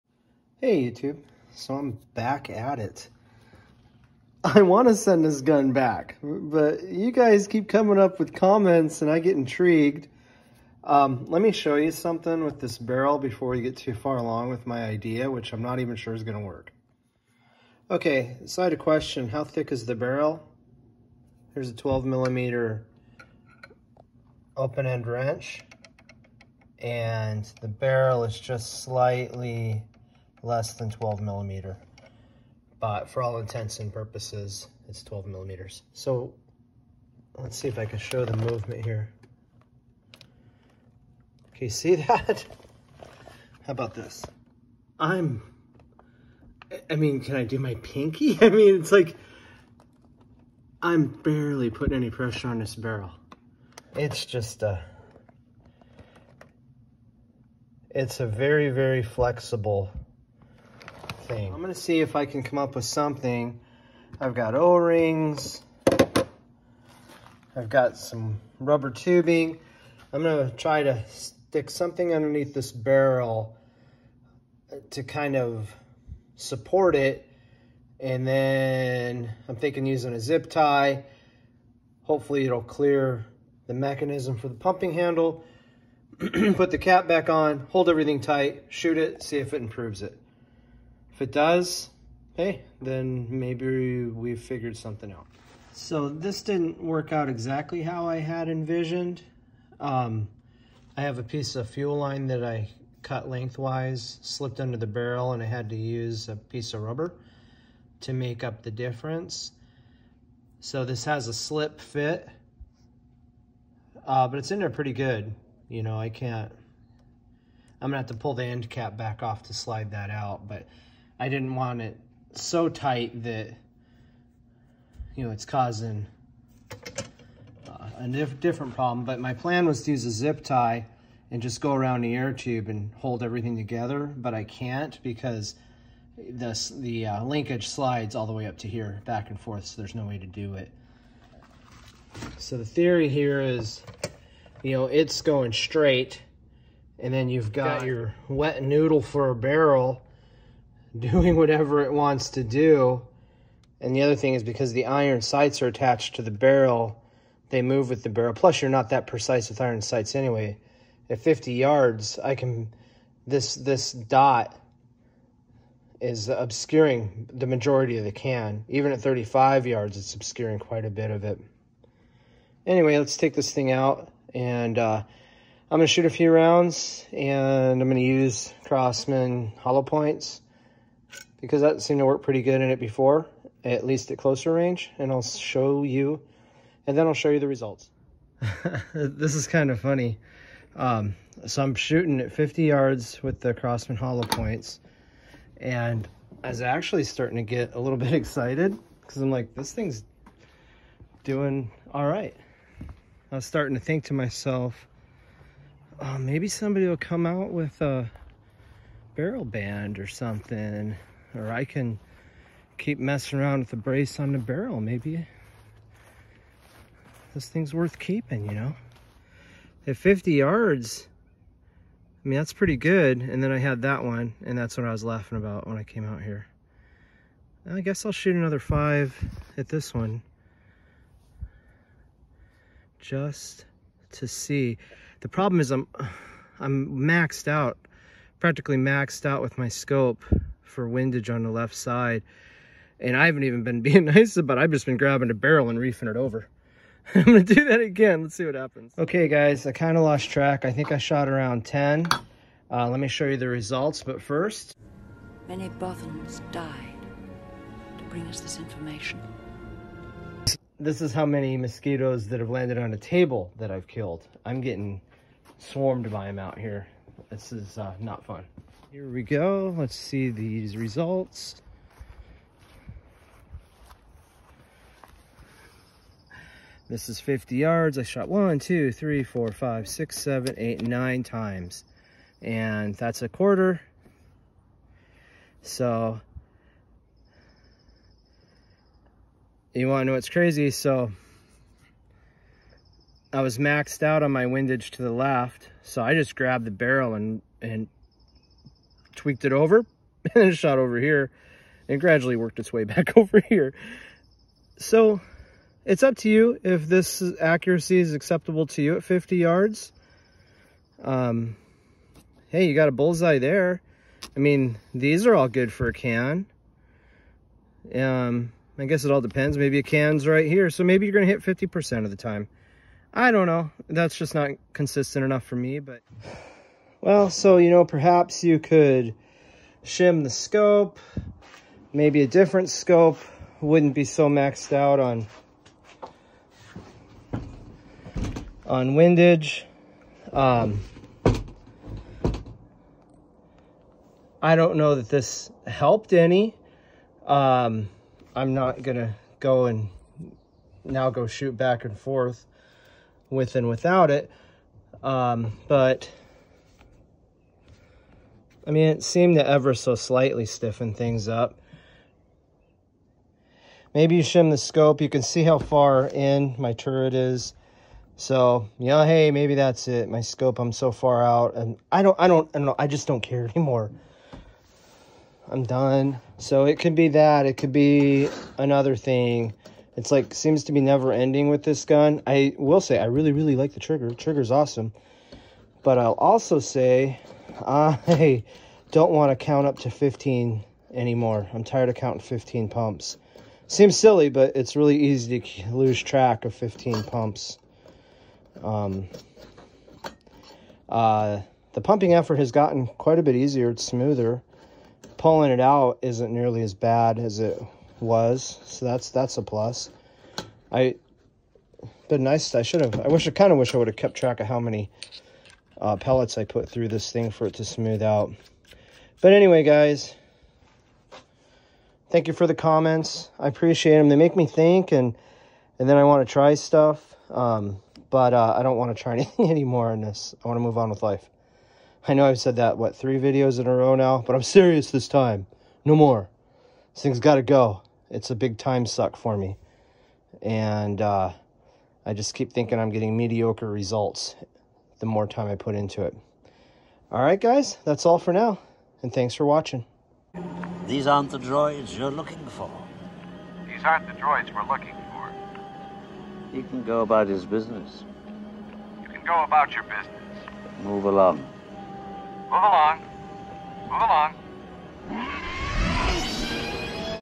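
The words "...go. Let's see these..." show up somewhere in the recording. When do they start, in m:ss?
4:29.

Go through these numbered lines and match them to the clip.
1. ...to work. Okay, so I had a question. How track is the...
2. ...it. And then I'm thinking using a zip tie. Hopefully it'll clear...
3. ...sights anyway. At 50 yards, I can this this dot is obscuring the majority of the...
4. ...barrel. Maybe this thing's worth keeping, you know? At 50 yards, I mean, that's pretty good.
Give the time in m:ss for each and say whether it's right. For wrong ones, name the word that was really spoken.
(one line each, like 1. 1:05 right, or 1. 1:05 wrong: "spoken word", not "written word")
1. 0:16 wrong: "thick", not "track"
2. 1:16 right
3. 2:39 right
4. 3:34 right.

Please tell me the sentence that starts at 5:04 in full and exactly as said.
So it's up to you if this accuracy is acceptable to you at 50 yards.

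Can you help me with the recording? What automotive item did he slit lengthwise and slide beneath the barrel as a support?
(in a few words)
fuel line.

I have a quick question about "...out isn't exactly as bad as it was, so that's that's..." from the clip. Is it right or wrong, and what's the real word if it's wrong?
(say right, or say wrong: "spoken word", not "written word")
wrong: "nearly", not "exactly".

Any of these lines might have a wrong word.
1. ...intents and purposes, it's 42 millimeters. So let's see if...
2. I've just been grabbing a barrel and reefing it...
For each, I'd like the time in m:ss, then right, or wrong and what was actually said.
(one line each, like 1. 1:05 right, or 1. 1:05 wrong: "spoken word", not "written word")
1. 0:33 wrong: "12", not "42"
2. 4:04 right.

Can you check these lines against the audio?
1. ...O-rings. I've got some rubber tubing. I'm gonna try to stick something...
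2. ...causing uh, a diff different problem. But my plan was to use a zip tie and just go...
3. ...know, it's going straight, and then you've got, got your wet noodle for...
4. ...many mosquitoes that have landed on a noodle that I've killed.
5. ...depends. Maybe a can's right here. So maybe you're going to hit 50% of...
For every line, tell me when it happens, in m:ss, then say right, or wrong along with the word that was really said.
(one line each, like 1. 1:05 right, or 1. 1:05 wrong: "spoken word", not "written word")
1. 1:04 right
2. 2:05 right
3. 2:24 right
4. 4:21 wrong: "table", not "noodle"
5. 5:19 right.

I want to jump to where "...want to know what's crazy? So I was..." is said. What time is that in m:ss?
4:49.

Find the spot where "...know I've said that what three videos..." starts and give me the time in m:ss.
7:12.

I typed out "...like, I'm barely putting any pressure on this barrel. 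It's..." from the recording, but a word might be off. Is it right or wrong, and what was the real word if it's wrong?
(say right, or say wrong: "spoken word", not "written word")
right.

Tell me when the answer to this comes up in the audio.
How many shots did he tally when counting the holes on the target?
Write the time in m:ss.
4:40.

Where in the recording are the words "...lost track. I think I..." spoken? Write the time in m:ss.
4:10.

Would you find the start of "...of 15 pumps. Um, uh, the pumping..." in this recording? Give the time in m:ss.
6:36.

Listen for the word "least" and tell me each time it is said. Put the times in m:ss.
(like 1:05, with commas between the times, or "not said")
3:03.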